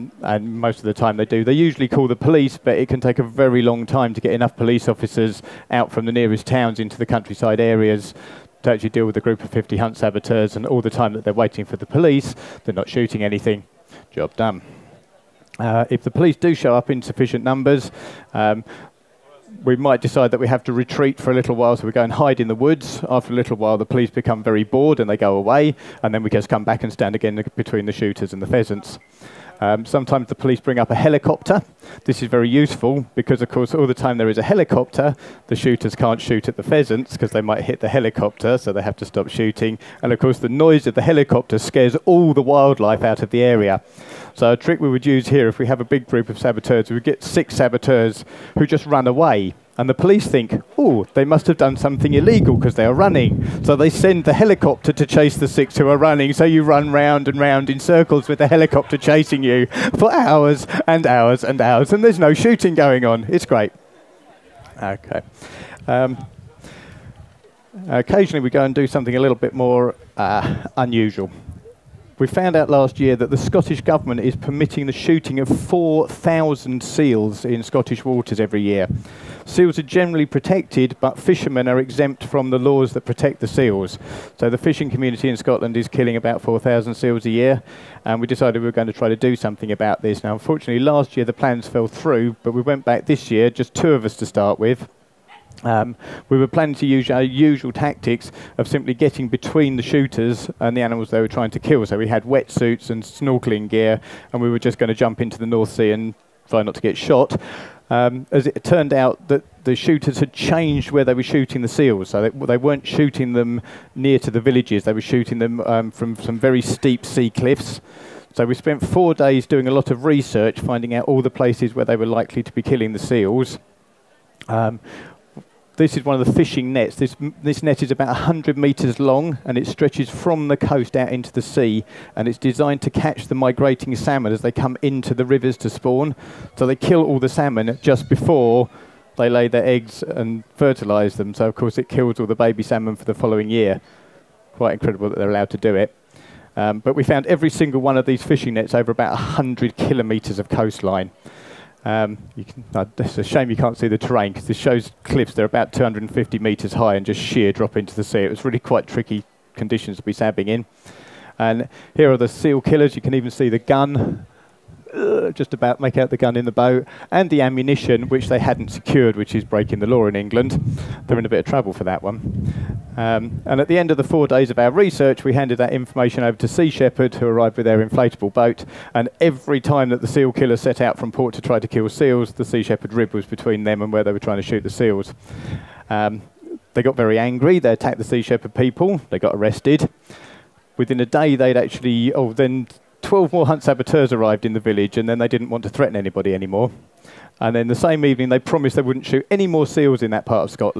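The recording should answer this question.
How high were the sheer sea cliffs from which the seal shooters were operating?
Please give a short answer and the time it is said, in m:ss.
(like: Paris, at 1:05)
250 metres, at 2:35.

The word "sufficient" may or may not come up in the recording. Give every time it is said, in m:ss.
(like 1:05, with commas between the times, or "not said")
0:17.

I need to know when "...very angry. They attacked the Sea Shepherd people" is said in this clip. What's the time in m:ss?
3:06.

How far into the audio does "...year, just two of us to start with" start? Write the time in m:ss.
1:33.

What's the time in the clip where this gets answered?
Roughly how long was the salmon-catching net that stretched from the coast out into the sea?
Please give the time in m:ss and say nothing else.
2:08.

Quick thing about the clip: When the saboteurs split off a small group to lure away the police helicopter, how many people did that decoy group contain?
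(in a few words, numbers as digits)
6.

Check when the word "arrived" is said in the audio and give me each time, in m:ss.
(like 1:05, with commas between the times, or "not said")
2:57, 3:14.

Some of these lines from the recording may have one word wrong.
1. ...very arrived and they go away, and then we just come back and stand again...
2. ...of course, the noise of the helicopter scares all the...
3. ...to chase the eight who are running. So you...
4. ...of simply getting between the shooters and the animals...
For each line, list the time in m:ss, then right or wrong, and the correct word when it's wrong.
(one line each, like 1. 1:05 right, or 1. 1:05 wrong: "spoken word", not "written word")
1. 0:24 wrong: "bored", not "arrived"
2. 0:40 right
3. 0:54 wrong: "six", not "eight"
4. 1:38 right.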